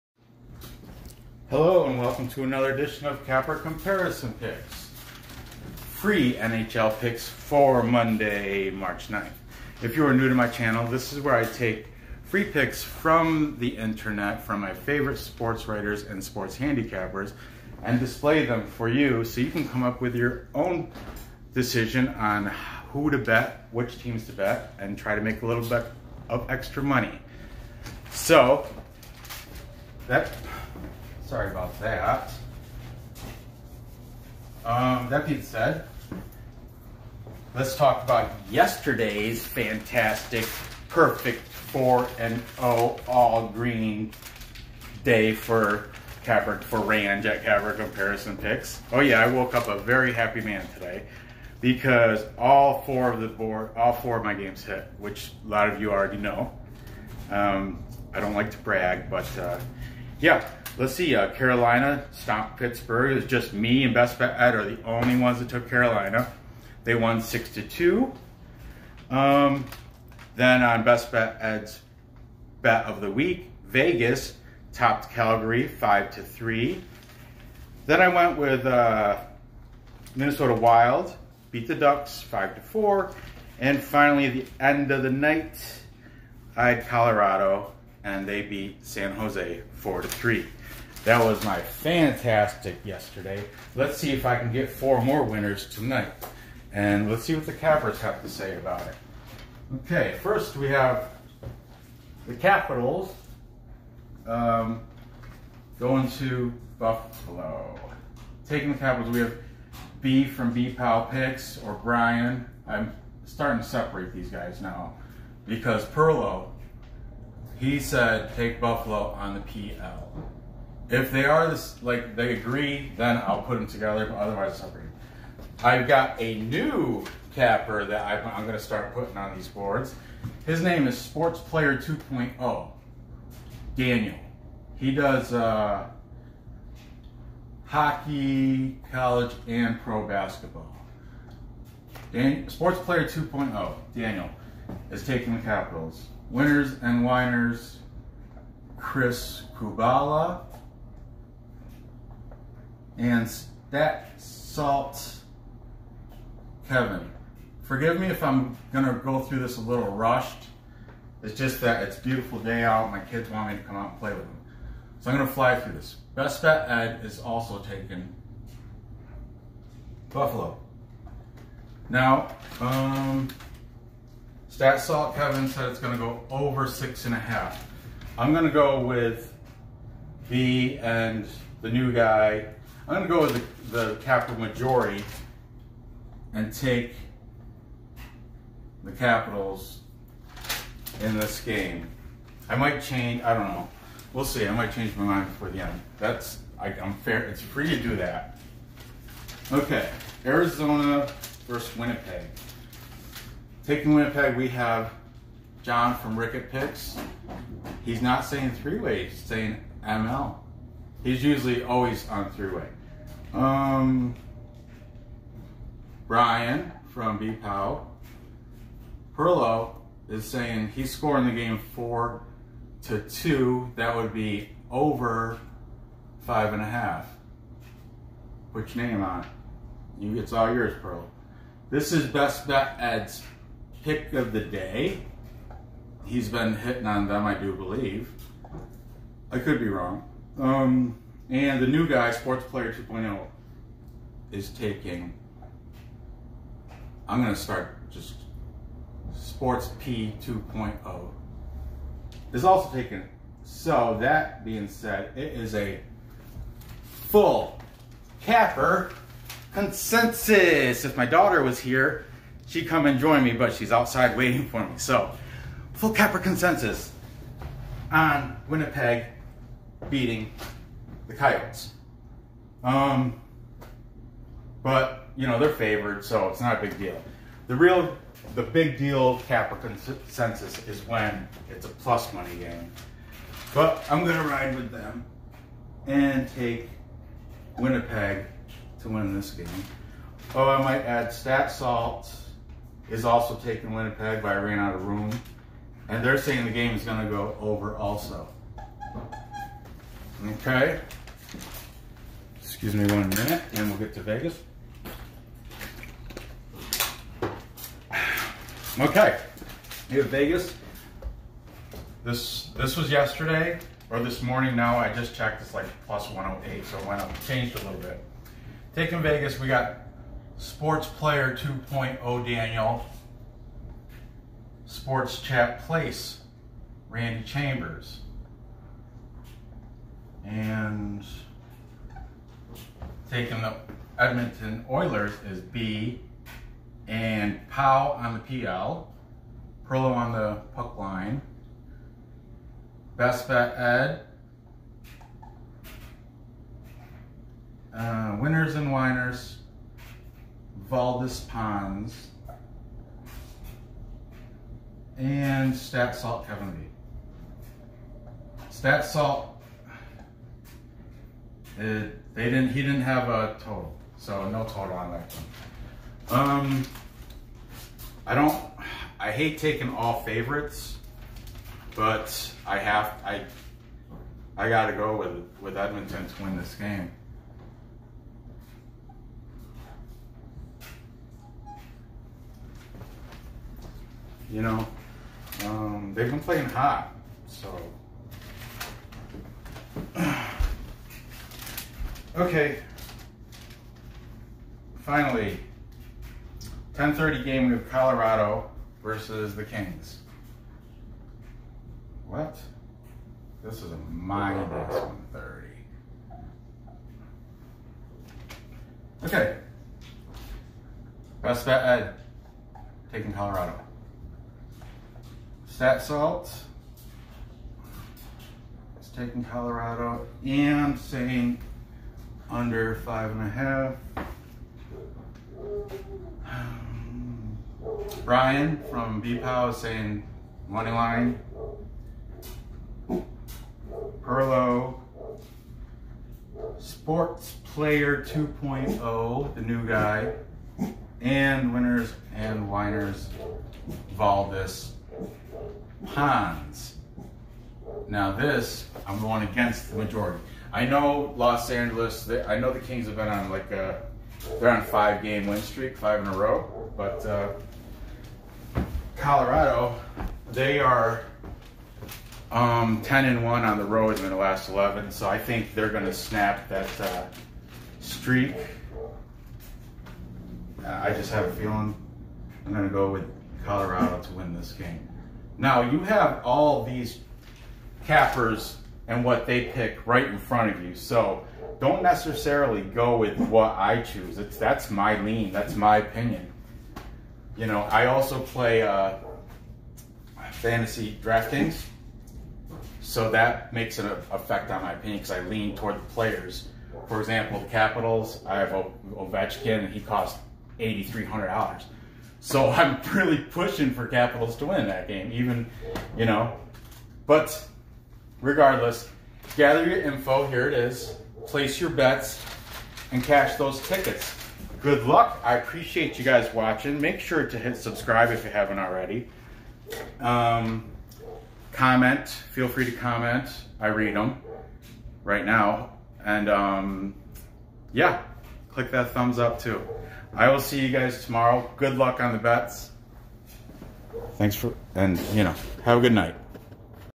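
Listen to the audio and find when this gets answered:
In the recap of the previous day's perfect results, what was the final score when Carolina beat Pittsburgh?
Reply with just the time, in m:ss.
1:07.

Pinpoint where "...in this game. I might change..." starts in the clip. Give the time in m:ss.
3:11.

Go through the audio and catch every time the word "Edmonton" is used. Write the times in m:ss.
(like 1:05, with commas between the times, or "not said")
5:33, 6:15.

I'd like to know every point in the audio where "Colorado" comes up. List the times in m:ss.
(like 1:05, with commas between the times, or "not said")
1:26, 6:37, 6:53, 6:59, 7:38, 7:53.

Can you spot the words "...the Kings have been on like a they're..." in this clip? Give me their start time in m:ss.
7:32.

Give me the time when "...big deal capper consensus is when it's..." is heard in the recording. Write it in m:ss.
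4:38.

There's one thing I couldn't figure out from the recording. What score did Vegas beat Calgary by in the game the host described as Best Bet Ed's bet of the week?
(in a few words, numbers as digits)
5 to 3.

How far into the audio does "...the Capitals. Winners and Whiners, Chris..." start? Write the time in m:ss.
2:25.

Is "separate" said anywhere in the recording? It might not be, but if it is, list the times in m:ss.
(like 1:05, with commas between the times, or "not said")
1:53, 2:04.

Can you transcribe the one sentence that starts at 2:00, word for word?
If they are this, like they agree, then I'll put them together.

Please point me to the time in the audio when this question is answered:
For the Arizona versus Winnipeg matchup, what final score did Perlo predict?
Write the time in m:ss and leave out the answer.
3:41.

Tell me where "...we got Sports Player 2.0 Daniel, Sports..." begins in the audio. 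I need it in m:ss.
5:19.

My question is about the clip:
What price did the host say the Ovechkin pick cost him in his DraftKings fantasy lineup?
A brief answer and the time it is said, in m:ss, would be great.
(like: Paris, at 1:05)
$8,300, at 8:20.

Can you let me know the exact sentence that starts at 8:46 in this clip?
And um, yeah, click that thumbs up too.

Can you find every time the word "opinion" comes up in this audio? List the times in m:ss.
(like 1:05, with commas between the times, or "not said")
8:05, 8:14.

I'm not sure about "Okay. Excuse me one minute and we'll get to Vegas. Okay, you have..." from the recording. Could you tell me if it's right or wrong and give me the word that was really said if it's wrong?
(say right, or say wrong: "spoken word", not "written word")
right.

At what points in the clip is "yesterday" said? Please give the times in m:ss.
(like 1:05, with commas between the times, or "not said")
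0:38, 1:32, 5:12.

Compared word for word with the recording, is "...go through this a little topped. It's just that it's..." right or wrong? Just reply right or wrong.
wrong.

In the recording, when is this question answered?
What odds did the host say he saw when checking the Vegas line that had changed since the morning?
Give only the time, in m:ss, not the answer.
5:15.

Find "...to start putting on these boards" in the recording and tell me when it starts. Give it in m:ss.
2:08.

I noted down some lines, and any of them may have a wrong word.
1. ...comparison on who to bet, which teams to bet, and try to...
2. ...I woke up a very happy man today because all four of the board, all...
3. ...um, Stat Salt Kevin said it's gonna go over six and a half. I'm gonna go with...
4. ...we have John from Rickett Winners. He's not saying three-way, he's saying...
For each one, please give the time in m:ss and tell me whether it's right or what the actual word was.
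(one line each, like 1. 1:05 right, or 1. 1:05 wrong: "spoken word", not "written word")
1. 0:21 wrong: "decision", not "comparison"
2. 0:49 right
3. 2:52 right
4. 3:24 wrong: "Picks", not "Winners".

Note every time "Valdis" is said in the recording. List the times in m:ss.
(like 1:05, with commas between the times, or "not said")
5:50, 7:23.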